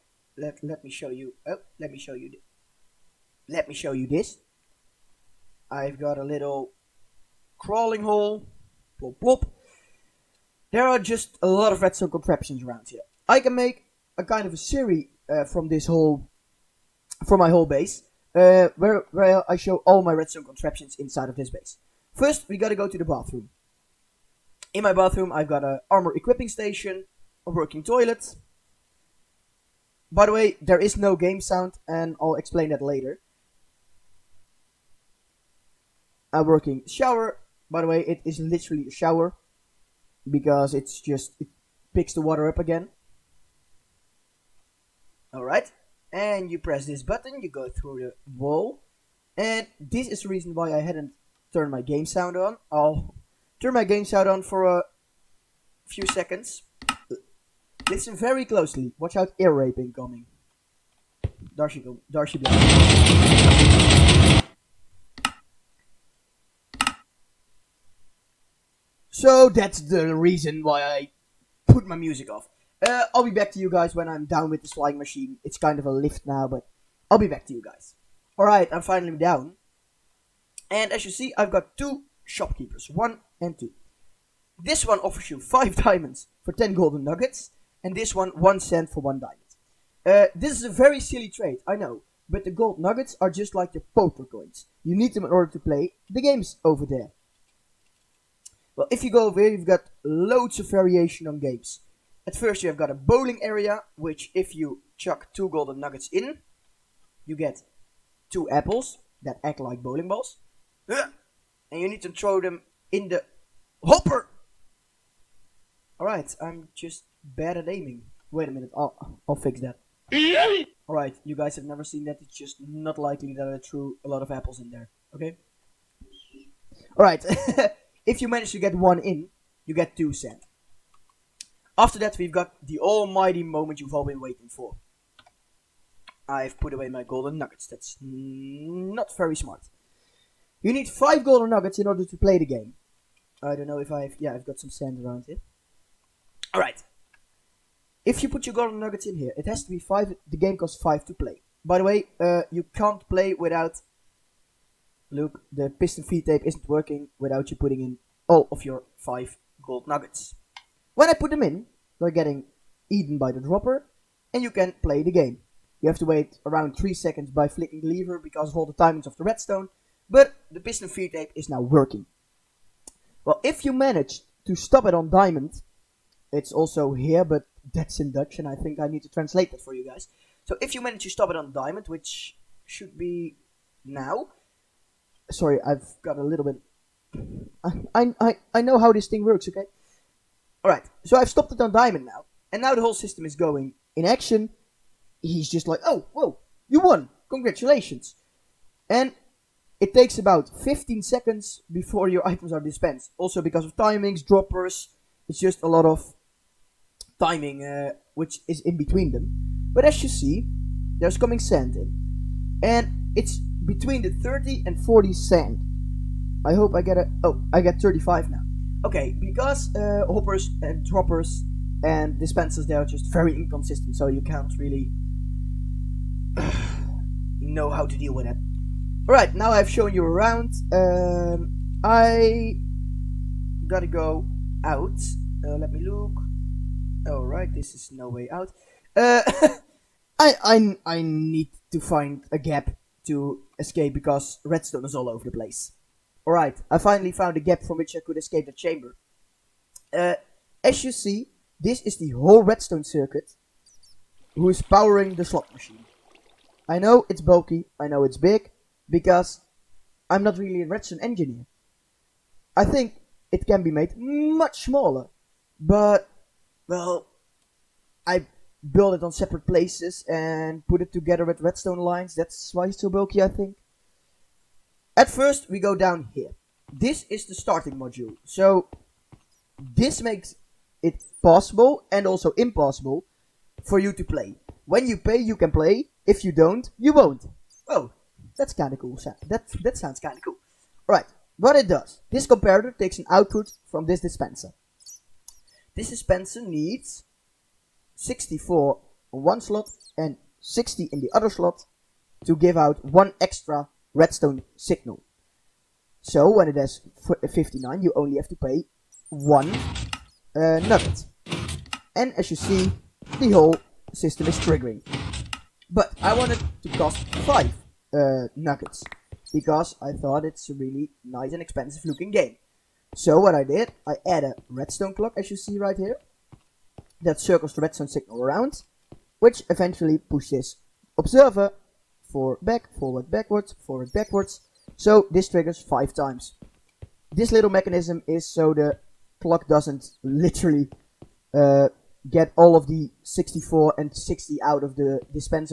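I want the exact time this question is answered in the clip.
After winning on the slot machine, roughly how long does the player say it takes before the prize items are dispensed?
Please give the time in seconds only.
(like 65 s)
200 s.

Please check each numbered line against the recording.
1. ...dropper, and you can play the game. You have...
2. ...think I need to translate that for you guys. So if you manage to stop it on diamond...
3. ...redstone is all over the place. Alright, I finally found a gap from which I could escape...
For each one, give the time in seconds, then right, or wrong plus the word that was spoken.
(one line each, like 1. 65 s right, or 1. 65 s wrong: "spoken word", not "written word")
1. 163 s right
2. 178 s right
3. 244 s right.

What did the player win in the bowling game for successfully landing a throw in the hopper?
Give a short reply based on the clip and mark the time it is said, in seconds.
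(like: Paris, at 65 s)
2 sand, at 129 s.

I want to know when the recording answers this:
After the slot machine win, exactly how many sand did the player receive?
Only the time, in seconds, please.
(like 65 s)
217 s.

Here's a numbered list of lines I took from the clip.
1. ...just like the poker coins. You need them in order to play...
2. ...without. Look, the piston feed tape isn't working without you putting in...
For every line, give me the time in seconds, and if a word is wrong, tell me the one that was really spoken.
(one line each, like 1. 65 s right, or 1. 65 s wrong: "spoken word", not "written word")
1. 93 s right
2. 153 s right.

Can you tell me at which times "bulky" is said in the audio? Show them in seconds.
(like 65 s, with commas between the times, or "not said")
257 s, 272 s.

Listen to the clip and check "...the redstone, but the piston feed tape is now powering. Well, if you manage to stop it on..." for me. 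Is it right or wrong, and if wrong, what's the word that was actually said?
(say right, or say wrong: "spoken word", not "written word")
wrong: "working", not "powering".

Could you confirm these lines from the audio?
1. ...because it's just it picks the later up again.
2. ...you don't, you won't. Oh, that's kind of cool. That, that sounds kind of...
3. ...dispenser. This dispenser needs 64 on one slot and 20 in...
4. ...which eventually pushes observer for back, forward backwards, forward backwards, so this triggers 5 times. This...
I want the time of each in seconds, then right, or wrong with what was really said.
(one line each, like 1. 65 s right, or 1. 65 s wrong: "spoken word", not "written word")
1. 40 s wrong: "water", not "later"
2. 286 s right
3. 294 s wrong: "60", not "20"
4. 329 s right.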